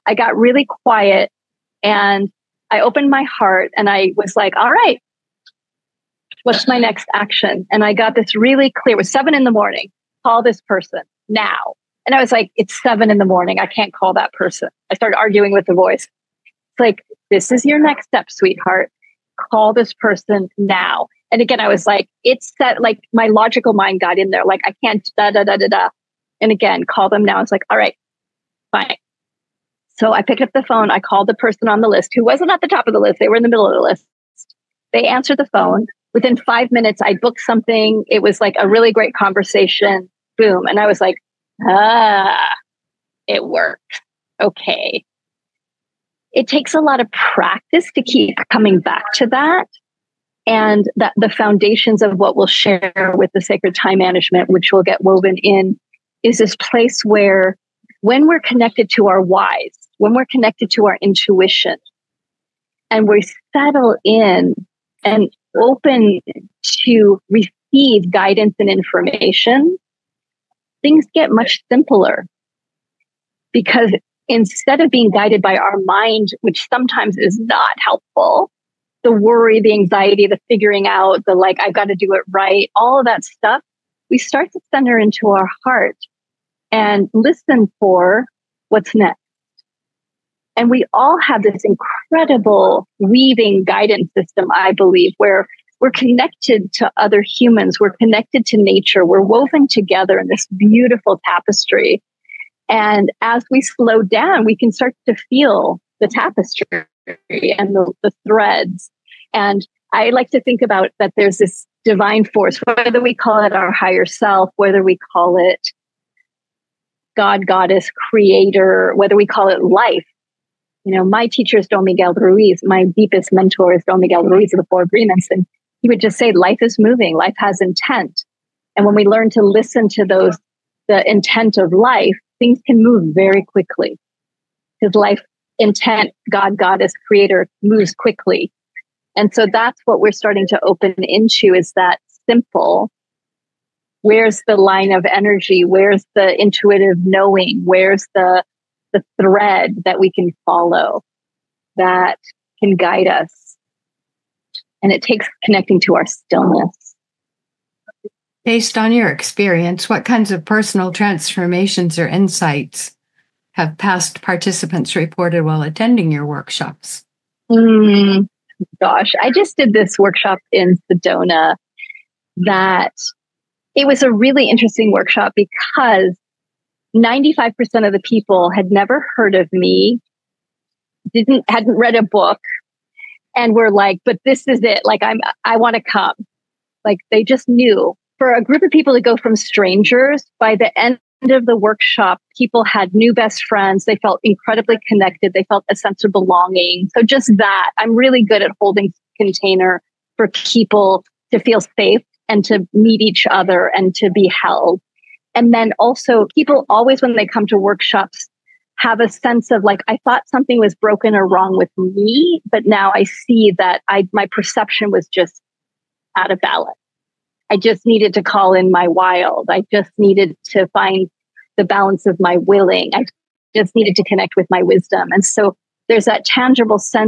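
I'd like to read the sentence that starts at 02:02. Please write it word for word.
My deepest mentor is Don Miguel Ruiz of the Four Agreements.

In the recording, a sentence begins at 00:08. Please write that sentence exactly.
It was seven in the morning.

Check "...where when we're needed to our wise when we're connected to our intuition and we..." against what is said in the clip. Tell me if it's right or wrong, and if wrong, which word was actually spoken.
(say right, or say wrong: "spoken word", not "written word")
wrong: "connected", not "needed".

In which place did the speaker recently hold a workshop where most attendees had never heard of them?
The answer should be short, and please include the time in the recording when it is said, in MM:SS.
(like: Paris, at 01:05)
Sedona, at 02:50.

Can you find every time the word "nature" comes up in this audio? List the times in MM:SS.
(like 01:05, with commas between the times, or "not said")
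01:38.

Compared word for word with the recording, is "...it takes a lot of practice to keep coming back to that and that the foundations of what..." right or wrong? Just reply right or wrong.
right.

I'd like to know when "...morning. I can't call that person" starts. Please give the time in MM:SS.
00:13.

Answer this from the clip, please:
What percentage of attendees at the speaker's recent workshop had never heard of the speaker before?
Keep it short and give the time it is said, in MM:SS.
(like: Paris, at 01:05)
95%, at 02:56.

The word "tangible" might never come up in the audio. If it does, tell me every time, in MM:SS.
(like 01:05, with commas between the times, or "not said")
03:46.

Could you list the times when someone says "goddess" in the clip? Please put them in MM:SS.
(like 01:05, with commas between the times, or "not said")
01:57, 02:16.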